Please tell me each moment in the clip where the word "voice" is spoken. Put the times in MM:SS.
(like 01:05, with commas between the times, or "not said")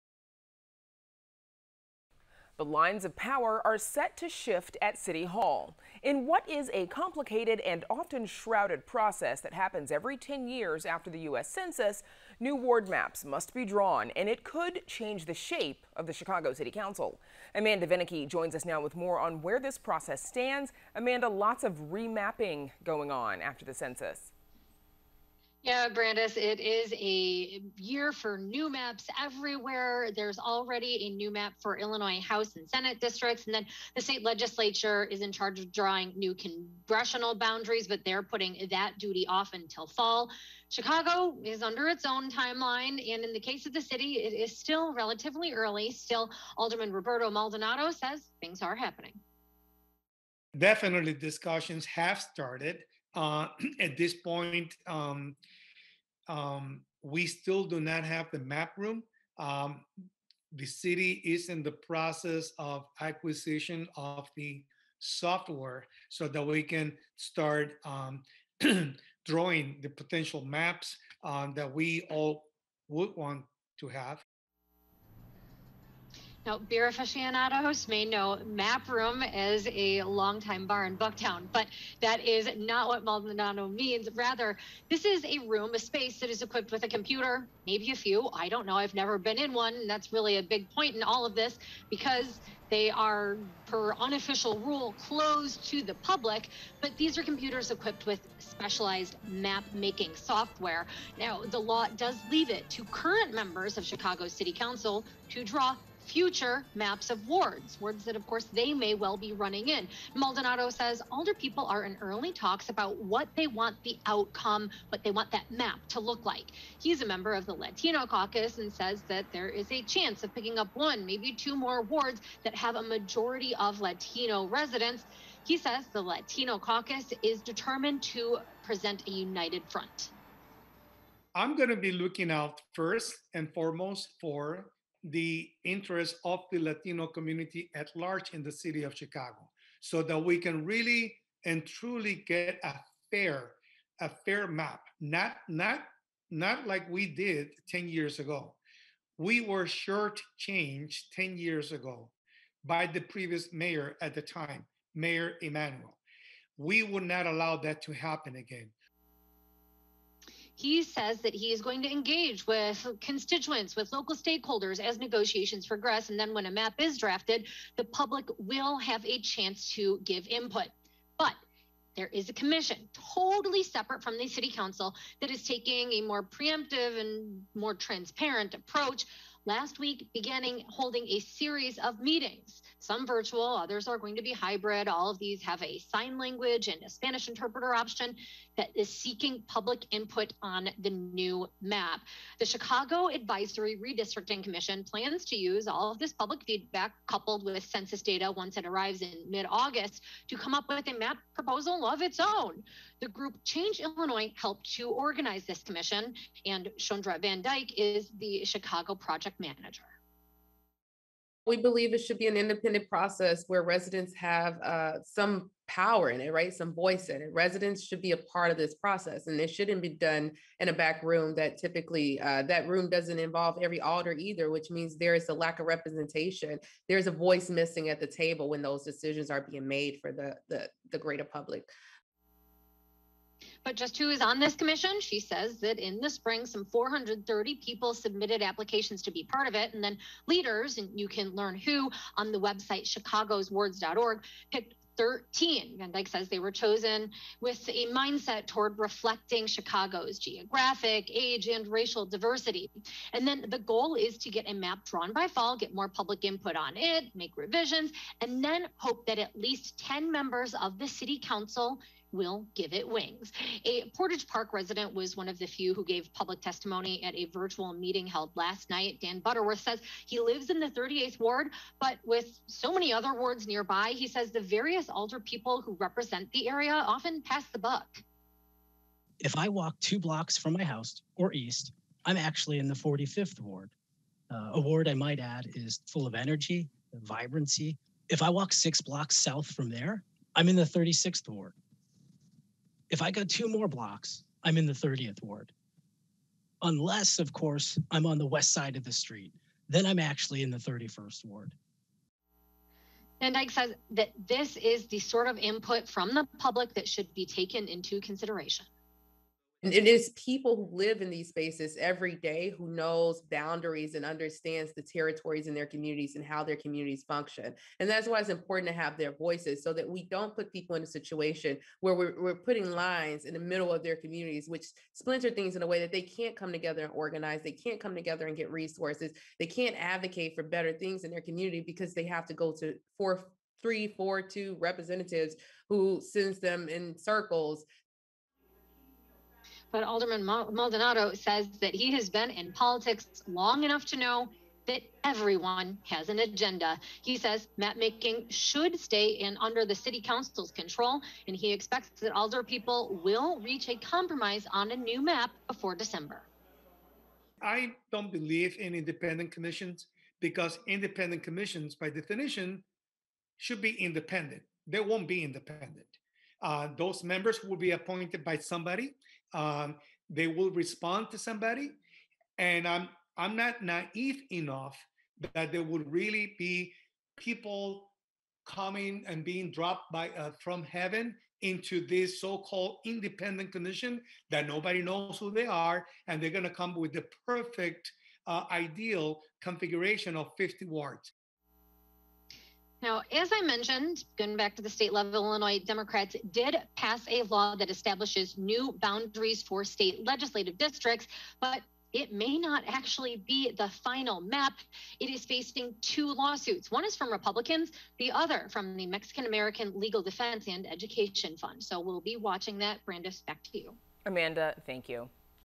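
03:36, 03:47, 05:19.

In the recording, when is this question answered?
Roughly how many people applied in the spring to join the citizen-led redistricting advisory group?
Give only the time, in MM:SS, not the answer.
03:56.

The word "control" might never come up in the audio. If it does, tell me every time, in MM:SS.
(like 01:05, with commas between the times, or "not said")
05:50.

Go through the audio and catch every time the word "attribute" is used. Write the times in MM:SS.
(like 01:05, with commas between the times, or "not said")
not said.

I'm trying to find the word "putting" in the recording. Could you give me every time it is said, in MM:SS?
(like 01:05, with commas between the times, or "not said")
00:38, 05:22.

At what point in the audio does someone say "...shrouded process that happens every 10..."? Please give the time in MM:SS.
00:08.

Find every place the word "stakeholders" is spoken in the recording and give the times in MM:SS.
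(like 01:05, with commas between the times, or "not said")
02:44.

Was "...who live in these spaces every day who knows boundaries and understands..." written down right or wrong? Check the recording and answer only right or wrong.
right.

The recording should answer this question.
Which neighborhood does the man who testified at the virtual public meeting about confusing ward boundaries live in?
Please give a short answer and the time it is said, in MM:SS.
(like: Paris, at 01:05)
Portage Park, at 04:23.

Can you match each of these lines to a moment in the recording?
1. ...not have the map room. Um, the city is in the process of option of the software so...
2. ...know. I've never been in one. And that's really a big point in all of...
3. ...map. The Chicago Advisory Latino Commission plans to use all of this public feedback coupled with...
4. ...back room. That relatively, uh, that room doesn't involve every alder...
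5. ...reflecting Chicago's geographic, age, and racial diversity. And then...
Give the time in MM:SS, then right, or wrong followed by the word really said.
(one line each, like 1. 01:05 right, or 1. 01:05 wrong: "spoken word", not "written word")
1. 00:57 wrong: "acquisition", not "option"
2. 01:28 right
3. 03:11 wrong: "Redistricting", not "Latino"
4. 03:40 wrong: "typically", not "relatively"
5. 04:08 right.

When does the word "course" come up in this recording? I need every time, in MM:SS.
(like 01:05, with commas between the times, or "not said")
01:48, 04:57.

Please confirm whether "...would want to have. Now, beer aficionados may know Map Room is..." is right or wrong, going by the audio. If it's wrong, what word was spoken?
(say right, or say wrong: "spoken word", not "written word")
right.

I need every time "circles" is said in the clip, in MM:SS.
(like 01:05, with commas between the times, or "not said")
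05:36.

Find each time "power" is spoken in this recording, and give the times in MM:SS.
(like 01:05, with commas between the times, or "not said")
00:03, 03:35.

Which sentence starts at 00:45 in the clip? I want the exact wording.
Still, Alderman Roberto Maldonado says things are happening.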